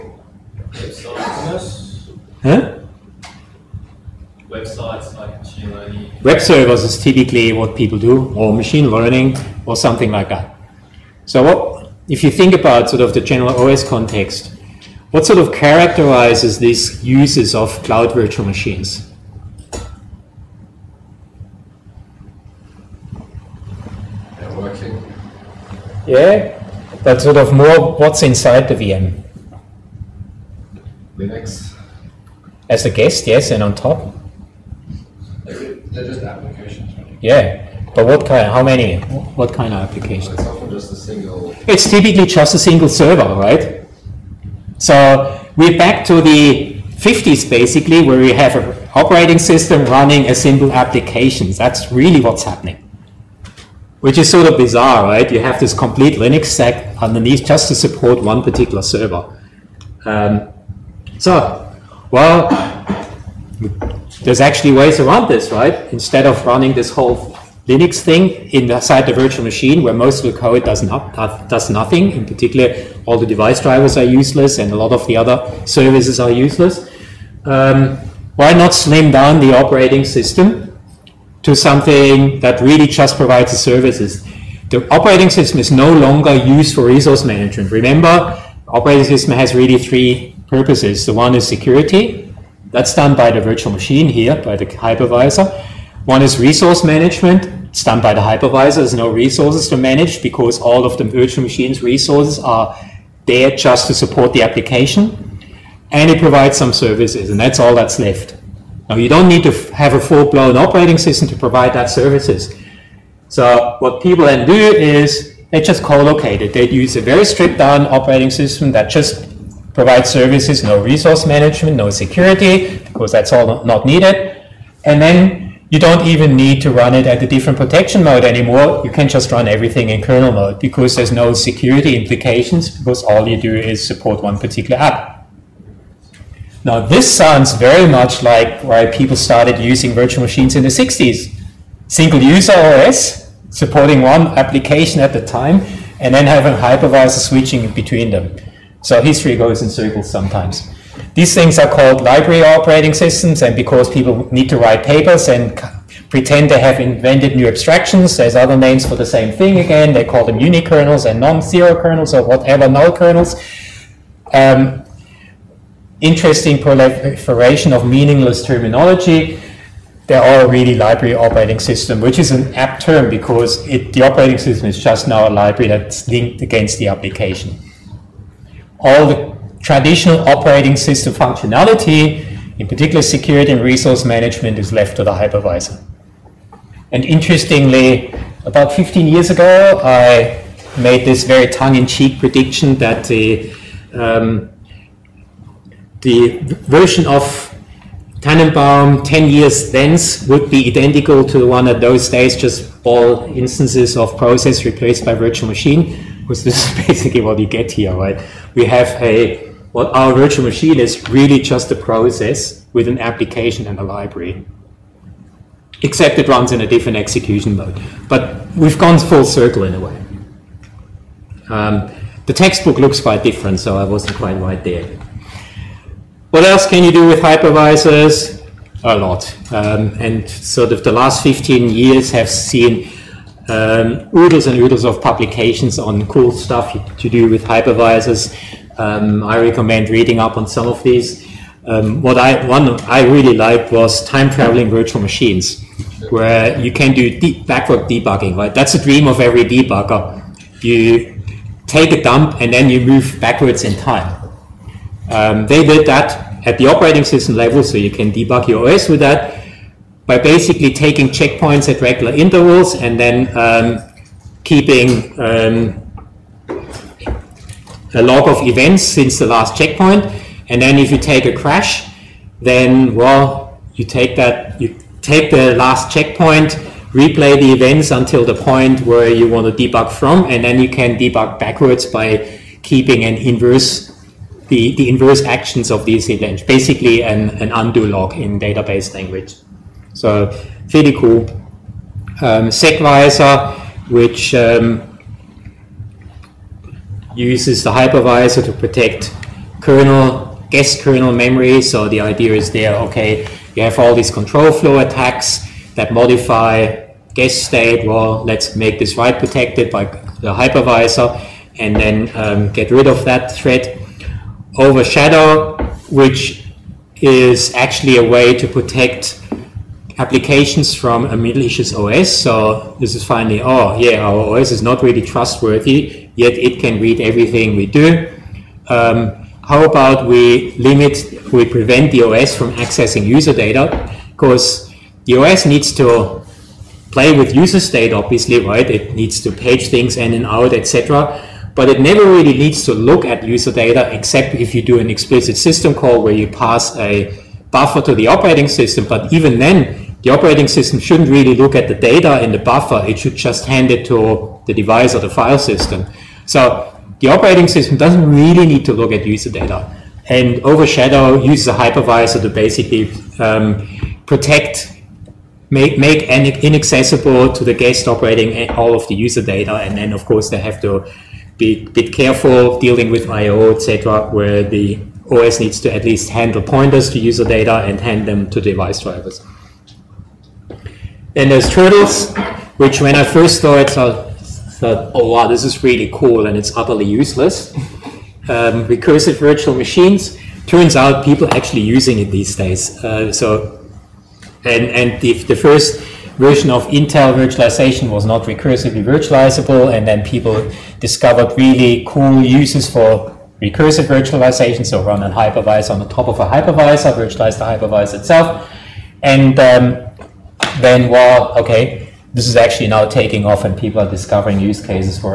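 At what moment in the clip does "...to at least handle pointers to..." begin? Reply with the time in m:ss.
6:15.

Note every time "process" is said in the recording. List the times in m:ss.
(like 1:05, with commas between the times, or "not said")
3:24, 3:31.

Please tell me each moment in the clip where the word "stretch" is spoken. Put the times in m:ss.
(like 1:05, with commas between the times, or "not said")
not said.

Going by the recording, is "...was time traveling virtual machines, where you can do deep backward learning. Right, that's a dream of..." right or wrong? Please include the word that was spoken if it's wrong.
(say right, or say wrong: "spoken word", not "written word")
wrong: "debugging", not "learning".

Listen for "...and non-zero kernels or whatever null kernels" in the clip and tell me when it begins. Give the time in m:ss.
2:41.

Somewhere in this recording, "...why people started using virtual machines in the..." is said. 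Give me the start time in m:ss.
2:18.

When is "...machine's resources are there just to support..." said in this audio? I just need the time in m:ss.
1:41.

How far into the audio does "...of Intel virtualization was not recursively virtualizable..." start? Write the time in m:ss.
6:36.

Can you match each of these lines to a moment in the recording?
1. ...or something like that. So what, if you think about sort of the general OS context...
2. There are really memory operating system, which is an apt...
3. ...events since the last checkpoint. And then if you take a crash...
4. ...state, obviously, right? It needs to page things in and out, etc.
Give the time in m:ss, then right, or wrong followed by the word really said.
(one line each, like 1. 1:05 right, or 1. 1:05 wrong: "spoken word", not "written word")
1. 0:09 right
2. 2:50 wrong: "library", not "memory"
3. 4:28 right
4. 5:37 right.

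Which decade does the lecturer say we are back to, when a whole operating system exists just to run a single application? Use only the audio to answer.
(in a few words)
the 50s.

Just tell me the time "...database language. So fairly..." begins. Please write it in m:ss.
4:48.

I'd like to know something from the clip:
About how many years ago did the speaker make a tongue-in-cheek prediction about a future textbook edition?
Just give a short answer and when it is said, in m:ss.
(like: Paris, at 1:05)
15, at 3:08.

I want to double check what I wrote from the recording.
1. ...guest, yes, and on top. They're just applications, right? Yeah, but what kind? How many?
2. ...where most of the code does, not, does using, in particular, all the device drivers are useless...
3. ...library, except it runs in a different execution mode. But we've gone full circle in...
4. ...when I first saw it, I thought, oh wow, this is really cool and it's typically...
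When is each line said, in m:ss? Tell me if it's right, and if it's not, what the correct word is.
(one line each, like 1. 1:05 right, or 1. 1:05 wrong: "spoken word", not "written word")
1. 0:32 right
2. 1:09 wrong: "nothing", not "using"
3. 3:33 right
4. 6:22 wrong: "utterly", not "typically".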